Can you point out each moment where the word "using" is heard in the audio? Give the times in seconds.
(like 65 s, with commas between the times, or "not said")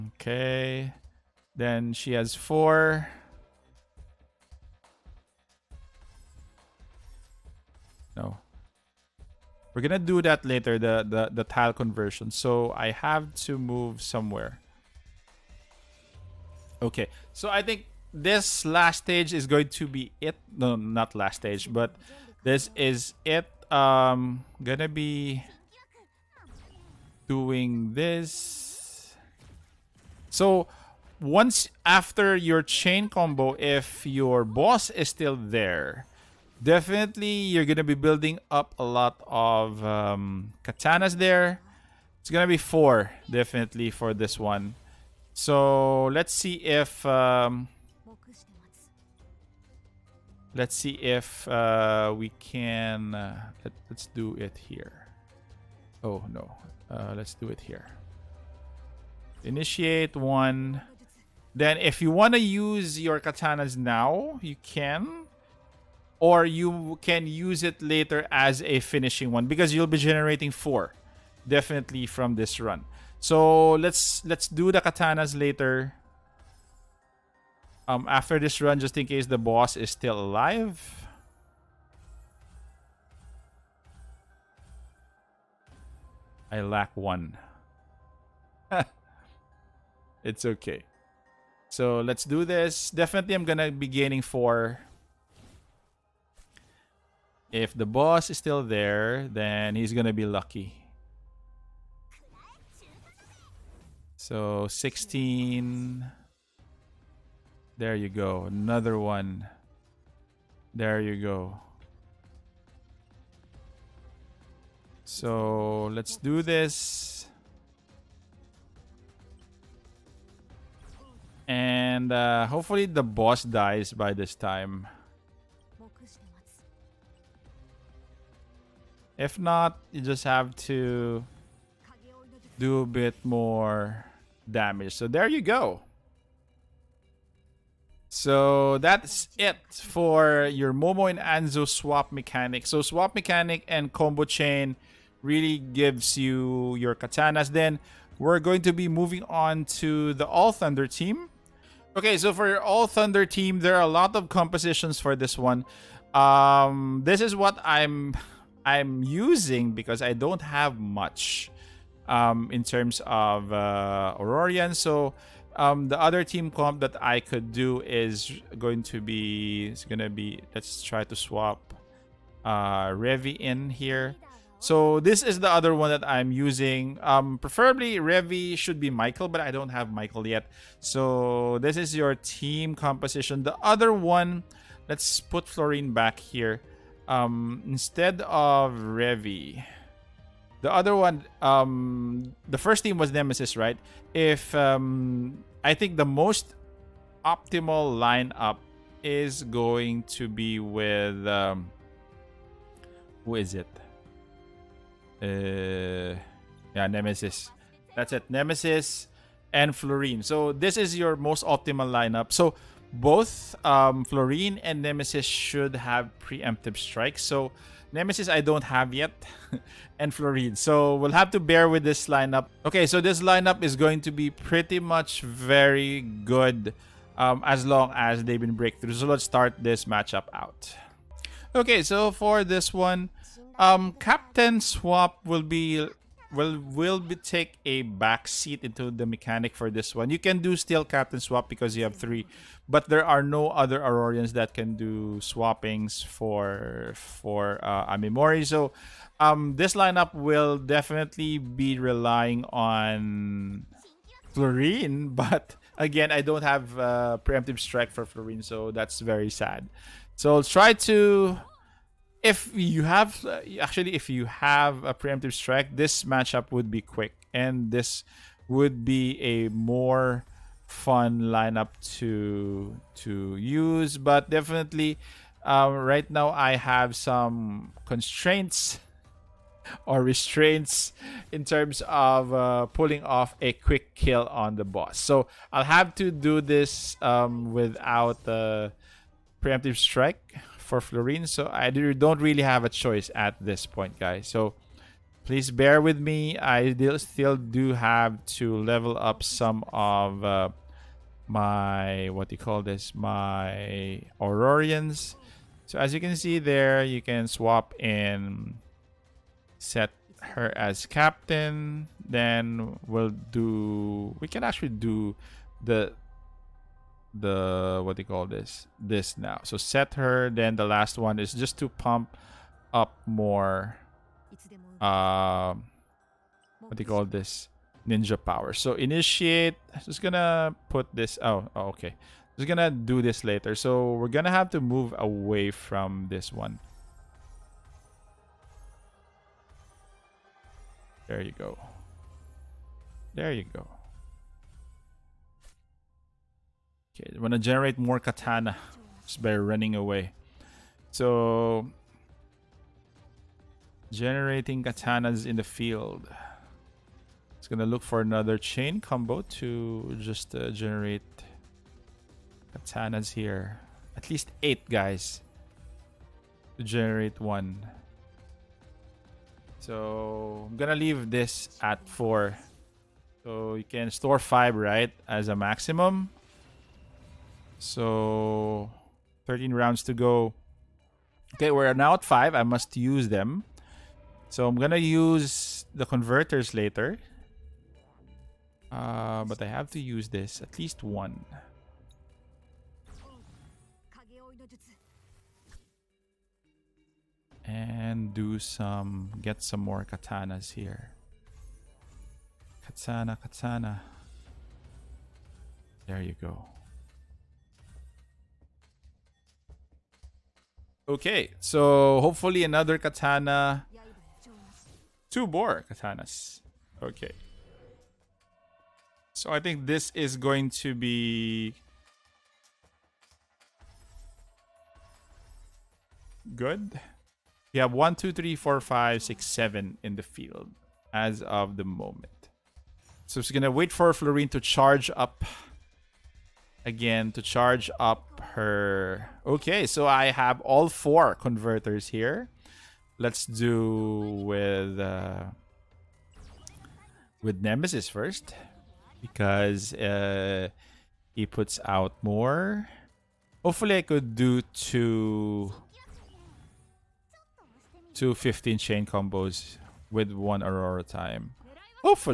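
159 s, 176 s.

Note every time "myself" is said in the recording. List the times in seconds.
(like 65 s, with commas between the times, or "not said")
not said.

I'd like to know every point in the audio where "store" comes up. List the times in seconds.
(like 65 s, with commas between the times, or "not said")
373 s.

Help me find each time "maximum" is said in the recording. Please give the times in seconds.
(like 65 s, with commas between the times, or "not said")
375 s.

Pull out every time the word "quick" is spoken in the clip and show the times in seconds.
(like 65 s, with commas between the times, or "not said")
266 s, 283 s.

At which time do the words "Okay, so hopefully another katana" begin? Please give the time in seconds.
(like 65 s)
410 s.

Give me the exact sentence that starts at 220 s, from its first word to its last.
So we'll have to bear with this lineup.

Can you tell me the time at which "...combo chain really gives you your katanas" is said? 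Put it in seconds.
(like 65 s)
143 s.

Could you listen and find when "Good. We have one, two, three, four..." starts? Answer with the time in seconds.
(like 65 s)
426 s.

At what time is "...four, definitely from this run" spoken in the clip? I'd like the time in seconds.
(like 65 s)
70 s.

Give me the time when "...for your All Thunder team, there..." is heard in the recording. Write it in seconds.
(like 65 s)
152 s.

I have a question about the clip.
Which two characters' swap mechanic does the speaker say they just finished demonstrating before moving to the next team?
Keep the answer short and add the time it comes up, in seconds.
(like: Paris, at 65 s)
Momo and Anzu, at 140 s.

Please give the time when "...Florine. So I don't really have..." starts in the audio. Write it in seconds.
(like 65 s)
290 s.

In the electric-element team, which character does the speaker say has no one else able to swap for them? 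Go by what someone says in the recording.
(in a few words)
Amemori.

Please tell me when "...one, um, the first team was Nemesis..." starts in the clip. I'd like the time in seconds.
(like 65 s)
190 s.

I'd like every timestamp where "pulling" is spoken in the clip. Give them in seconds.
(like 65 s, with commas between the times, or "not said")
282 s.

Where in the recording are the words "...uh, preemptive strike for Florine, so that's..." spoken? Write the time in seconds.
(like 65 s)
256 s.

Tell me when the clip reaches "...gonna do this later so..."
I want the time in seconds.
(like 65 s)
332 s.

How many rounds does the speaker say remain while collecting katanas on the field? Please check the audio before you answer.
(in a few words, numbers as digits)
13.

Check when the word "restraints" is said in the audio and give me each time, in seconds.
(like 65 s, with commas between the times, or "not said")
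280 s.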